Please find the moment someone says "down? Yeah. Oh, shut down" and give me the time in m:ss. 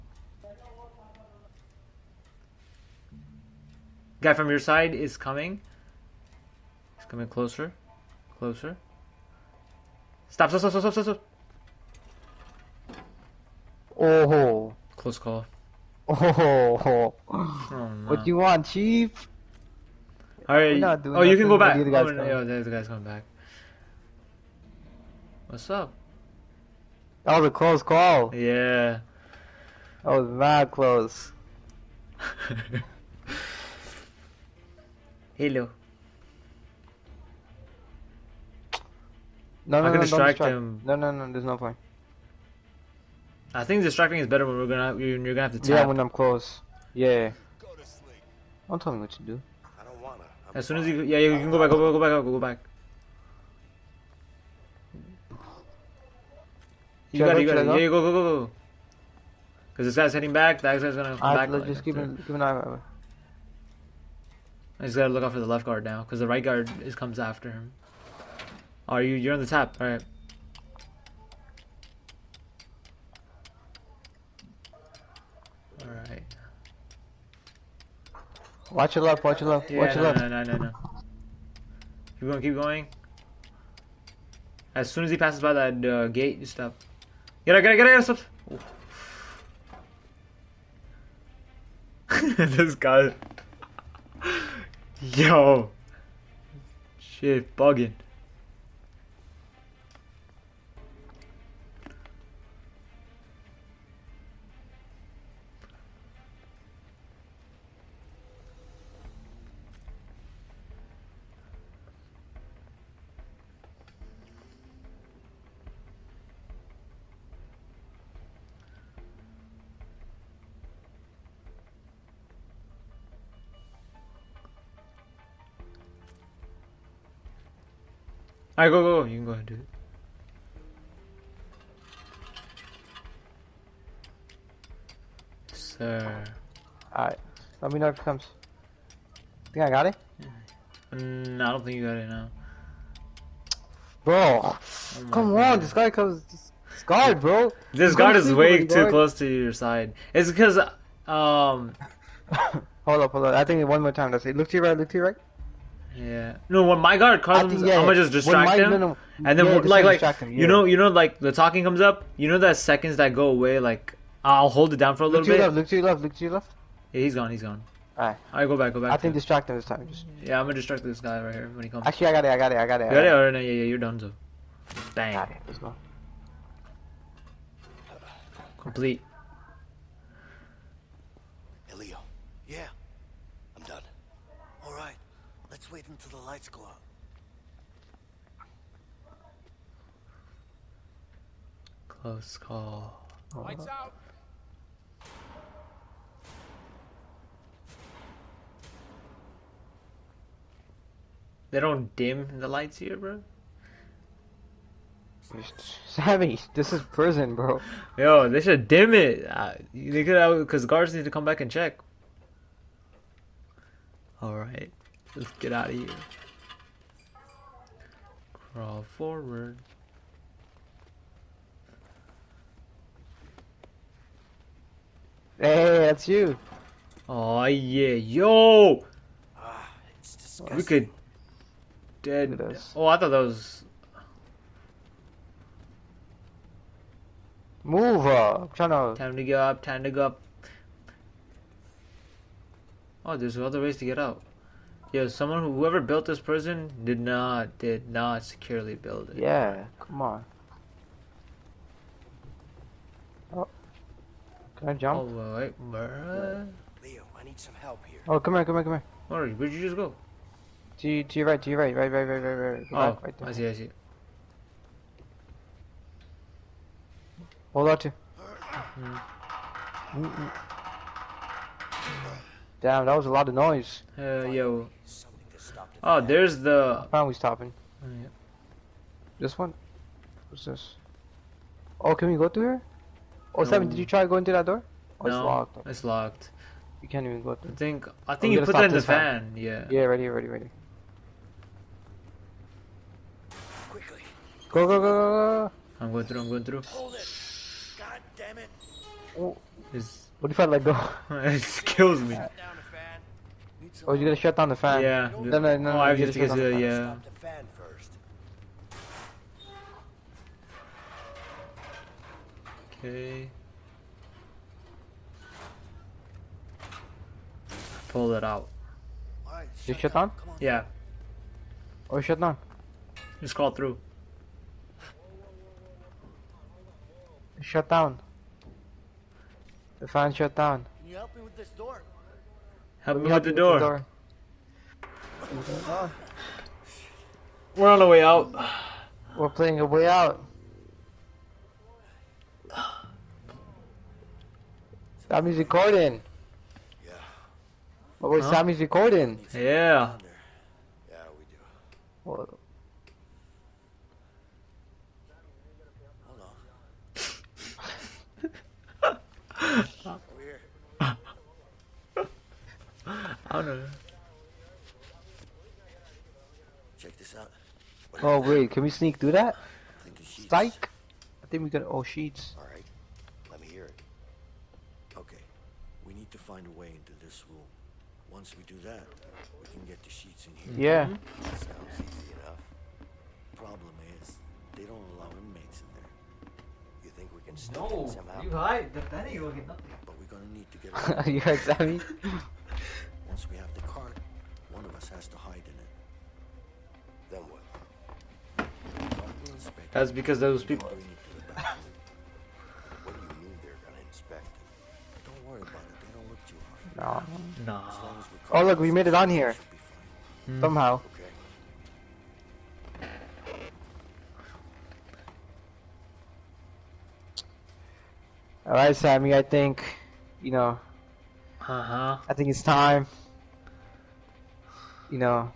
5:20.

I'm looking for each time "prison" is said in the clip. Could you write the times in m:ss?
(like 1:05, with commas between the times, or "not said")
3:26, 4:06.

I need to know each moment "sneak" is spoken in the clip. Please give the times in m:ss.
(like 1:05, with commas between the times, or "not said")
6:08, 6:27.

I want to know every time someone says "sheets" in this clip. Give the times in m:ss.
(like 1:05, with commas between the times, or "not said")
6:11, 6:19.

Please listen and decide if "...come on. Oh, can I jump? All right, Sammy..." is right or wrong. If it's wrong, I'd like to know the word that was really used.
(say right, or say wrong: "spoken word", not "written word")
wrong: "Leo", not "Sammy".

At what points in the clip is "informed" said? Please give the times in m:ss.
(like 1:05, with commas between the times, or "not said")
not said.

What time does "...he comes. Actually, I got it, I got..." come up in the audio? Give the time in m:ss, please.
2:51.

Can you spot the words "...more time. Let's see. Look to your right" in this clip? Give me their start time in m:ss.
2:33.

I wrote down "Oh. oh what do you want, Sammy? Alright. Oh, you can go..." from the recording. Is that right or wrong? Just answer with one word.
wrong.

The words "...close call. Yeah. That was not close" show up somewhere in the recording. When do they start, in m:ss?
0:27.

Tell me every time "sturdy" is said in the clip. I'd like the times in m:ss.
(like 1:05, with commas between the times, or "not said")
not said.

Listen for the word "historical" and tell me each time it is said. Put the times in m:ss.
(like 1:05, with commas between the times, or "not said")
not said.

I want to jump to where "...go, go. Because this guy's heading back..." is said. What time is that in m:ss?
0:58.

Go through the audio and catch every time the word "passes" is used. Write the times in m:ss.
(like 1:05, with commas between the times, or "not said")
1:25.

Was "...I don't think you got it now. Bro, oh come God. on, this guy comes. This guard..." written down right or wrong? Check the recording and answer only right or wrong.
right.